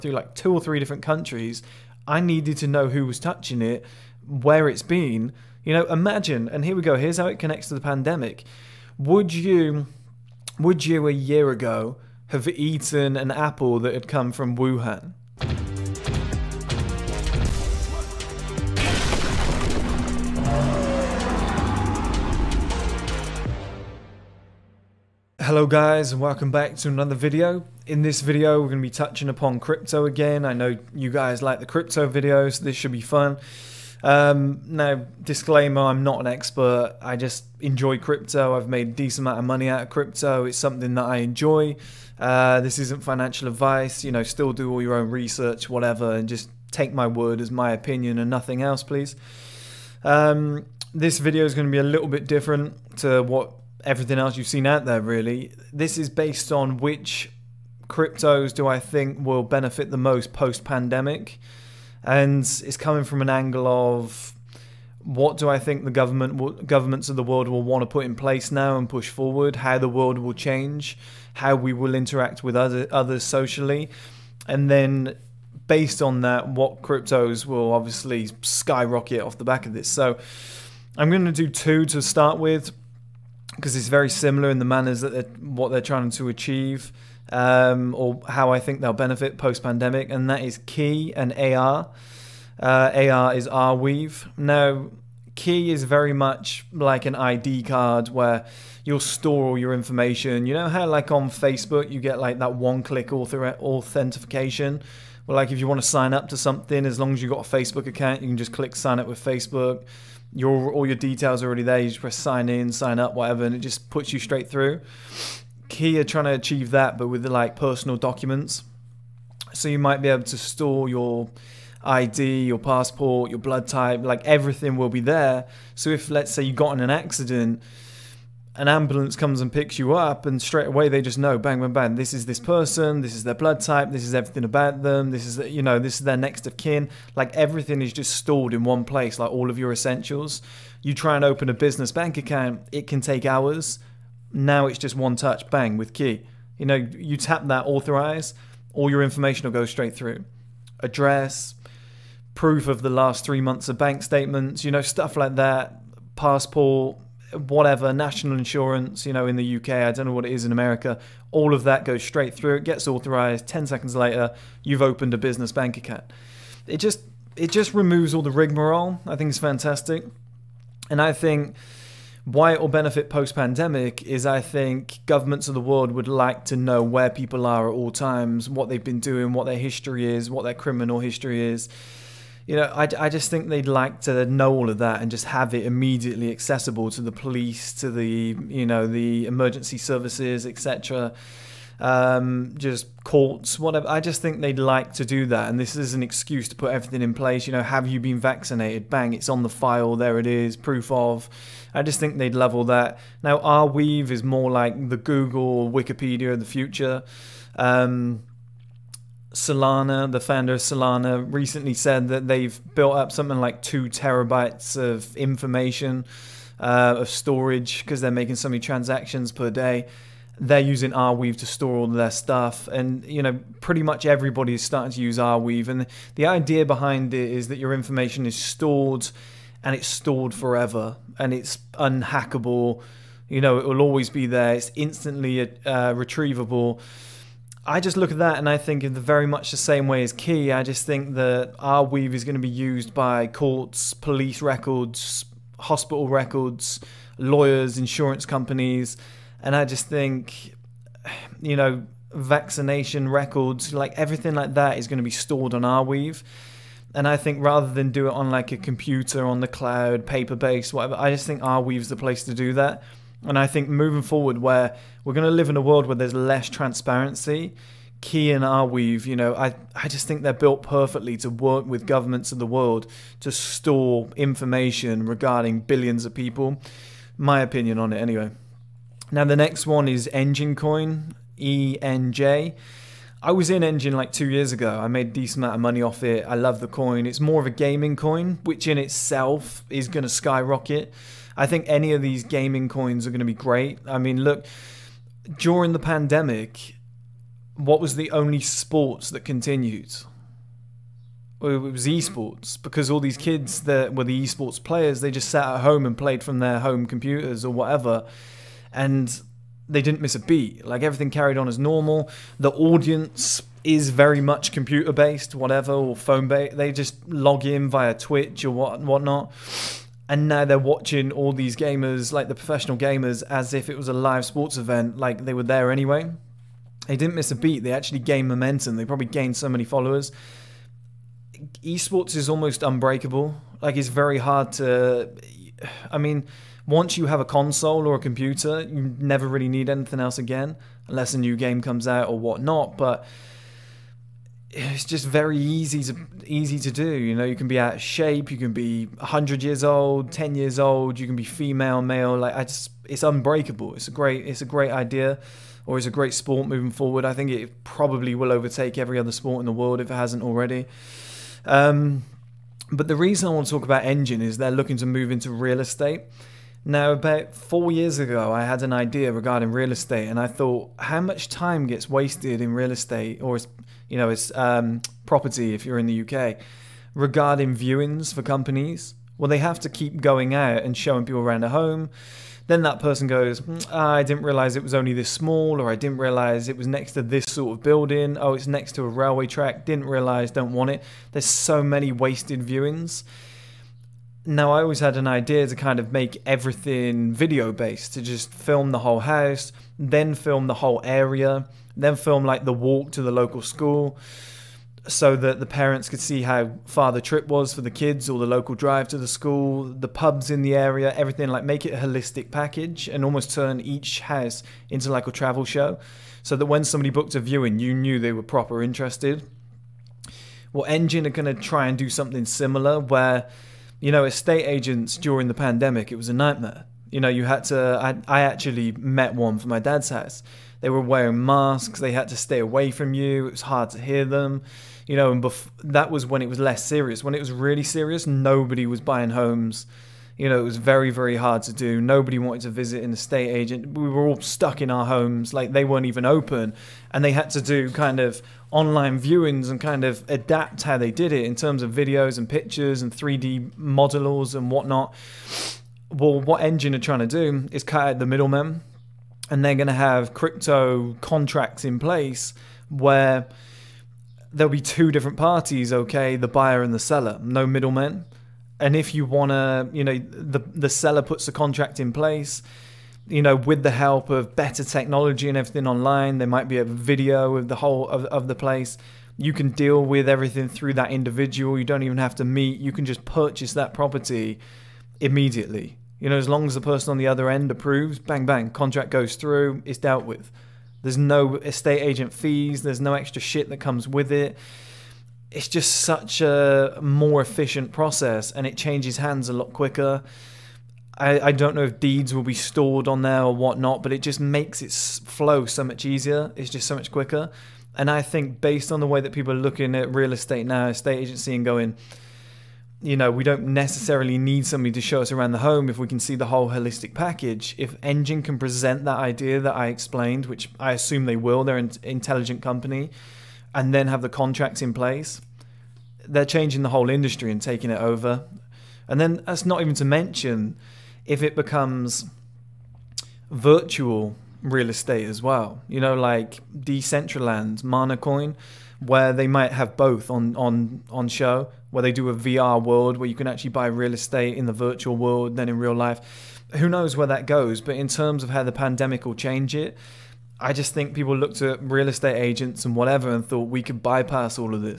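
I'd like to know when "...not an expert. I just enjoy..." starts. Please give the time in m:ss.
0:36.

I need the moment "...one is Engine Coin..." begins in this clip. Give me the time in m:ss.
4:39.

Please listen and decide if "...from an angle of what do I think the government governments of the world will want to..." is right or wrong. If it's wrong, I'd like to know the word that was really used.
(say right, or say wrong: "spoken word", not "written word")
right.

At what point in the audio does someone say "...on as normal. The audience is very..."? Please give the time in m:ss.
5:11.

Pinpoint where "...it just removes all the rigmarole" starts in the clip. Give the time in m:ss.
2:47.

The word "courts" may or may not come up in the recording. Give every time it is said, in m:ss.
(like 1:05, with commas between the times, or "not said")
3:13, 4:03.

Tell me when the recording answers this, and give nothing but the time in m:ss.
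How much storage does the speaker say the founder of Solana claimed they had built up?
3:33.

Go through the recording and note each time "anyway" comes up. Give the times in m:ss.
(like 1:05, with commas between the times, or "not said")
4:37, 5:25.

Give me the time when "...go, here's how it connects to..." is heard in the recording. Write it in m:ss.
0:06.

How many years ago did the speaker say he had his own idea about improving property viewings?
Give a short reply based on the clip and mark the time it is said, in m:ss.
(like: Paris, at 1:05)
4, at 6:07.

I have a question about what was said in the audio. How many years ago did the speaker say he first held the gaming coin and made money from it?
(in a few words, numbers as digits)
2.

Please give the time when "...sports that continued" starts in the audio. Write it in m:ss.
4:58.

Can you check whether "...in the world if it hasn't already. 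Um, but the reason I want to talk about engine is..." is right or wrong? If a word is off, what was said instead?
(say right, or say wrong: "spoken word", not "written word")
right.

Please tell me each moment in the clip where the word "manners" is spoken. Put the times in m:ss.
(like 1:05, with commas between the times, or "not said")
1:24.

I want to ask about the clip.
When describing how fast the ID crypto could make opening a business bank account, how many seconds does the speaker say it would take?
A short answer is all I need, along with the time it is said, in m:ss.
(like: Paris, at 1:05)
10, at 2:43.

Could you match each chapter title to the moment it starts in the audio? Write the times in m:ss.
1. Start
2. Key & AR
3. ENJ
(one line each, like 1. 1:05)
1. 0:25
2. 1:28
3. 4:38.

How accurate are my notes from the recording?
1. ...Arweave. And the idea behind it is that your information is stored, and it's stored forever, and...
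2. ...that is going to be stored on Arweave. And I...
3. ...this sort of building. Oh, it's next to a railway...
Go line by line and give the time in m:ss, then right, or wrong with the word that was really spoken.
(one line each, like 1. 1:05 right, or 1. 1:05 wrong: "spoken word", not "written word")
1. 3:45 right
2. 4:14 right
3. 6:27 right.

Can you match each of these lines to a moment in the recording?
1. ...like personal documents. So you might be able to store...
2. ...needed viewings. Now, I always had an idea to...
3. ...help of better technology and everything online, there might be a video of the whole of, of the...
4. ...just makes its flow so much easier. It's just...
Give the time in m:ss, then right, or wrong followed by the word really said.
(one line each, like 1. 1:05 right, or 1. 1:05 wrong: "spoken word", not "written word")
1. 1:57 right
2. 6:31 wrong: "wasted", not "needed"
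3. 7:53 right
4. 8:24 right.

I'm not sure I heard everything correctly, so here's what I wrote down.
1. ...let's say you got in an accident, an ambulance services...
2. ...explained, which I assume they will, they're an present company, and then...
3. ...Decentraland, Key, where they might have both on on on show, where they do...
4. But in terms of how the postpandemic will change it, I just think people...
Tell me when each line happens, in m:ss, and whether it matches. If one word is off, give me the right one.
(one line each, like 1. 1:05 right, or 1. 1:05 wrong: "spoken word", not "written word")
1. 2:06 wrong: "comes", not "services"
2. 8:39 wrong: "intelligent", not "present"
3. 8:56 wrong: "Manacoin", not "Key"
4. 9:07 wrong: "pandemic", not "postpandemic".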